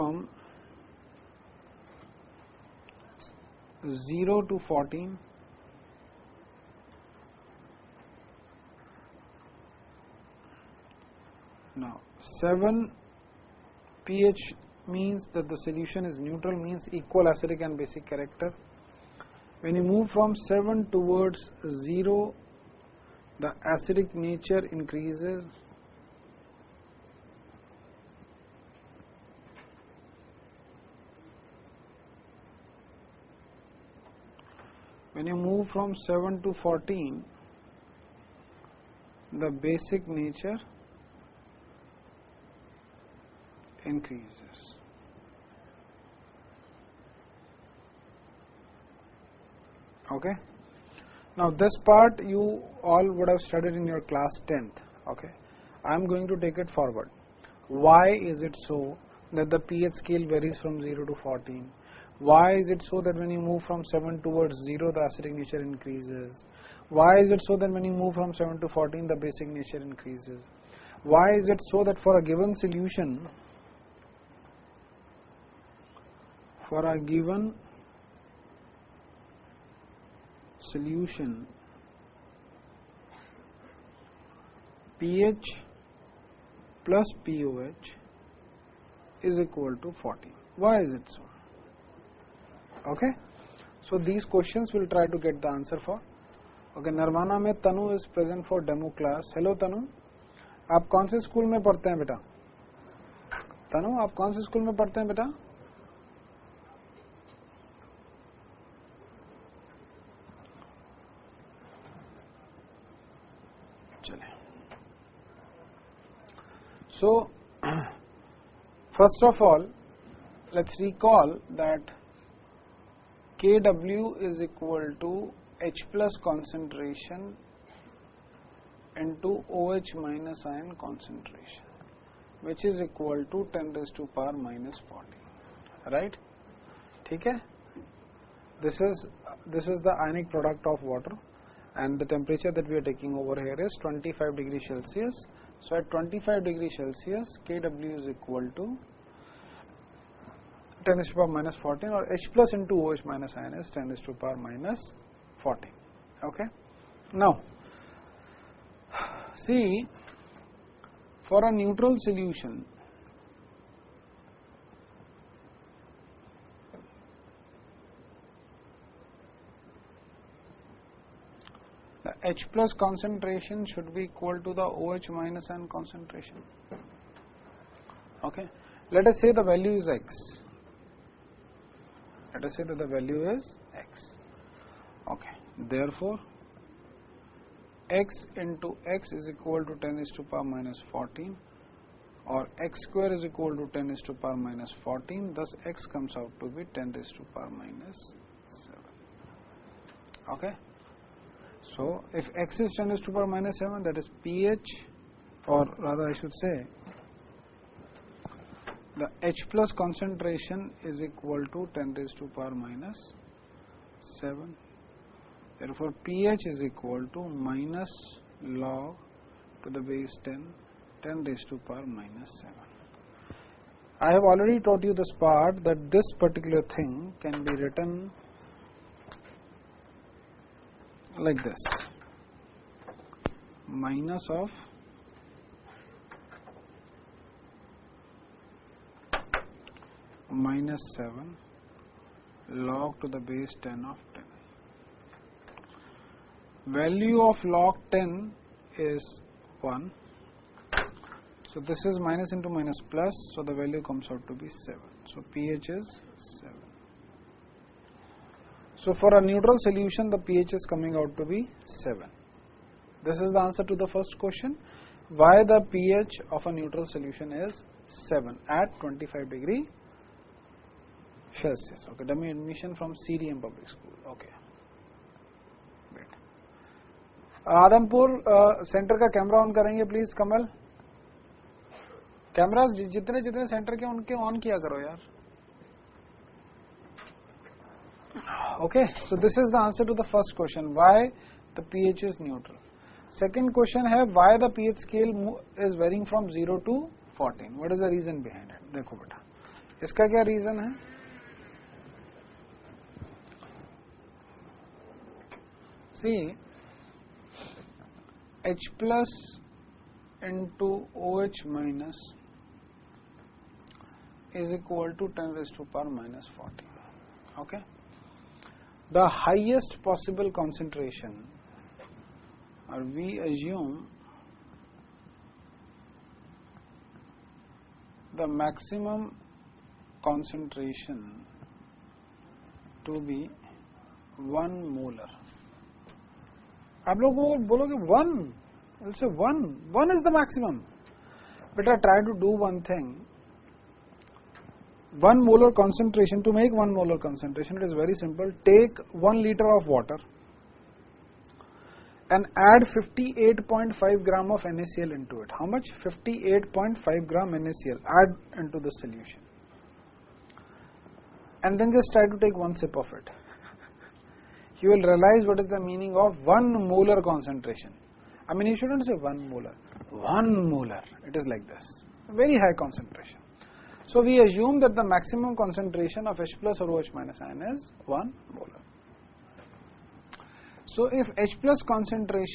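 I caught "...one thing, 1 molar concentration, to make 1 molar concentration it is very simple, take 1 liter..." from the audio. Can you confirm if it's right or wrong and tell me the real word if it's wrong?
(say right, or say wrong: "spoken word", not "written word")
right.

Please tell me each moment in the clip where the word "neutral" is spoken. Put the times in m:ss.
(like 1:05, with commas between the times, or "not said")
0:16, 2:41, 4:19, 4:26, 4:52.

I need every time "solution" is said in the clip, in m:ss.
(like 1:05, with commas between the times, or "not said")
0:15, 1:12, 1:20, 2:41, 4:19, 4:26, 5:58.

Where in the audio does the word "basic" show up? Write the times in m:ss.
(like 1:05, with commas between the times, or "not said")
0:17, 0:39, 1:09.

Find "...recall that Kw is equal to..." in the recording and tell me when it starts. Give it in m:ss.
2:00.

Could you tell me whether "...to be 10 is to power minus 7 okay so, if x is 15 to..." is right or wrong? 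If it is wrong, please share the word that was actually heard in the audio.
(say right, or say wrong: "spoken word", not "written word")
wrong: "10", not "15".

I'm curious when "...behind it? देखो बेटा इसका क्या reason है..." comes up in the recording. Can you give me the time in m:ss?
4:58.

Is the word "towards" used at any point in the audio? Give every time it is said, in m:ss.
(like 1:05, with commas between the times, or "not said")
0:20, 1:04.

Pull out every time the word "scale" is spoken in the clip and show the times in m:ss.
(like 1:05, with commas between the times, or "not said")
0:59, 4:54.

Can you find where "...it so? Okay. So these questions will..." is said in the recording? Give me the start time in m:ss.
1:30.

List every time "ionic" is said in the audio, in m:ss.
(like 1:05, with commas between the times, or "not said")
2:20.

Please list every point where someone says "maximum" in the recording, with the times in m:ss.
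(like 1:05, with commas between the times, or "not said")
5:28, 5:40, 6:14.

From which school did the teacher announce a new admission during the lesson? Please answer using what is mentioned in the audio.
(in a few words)
CDM public school.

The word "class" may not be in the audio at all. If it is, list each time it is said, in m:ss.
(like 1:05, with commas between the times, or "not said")
0:54, 1:39.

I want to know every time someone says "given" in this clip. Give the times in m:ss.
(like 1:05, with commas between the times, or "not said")
1:12, 1:17.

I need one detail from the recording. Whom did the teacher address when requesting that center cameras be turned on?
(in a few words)
Kamal.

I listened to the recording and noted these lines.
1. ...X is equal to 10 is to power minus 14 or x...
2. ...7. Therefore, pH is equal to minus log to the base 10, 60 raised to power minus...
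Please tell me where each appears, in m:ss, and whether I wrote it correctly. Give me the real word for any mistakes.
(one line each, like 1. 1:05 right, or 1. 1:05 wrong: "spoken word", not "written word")
1. 3:08 right
2. 3:34 wrong: "10", not "60".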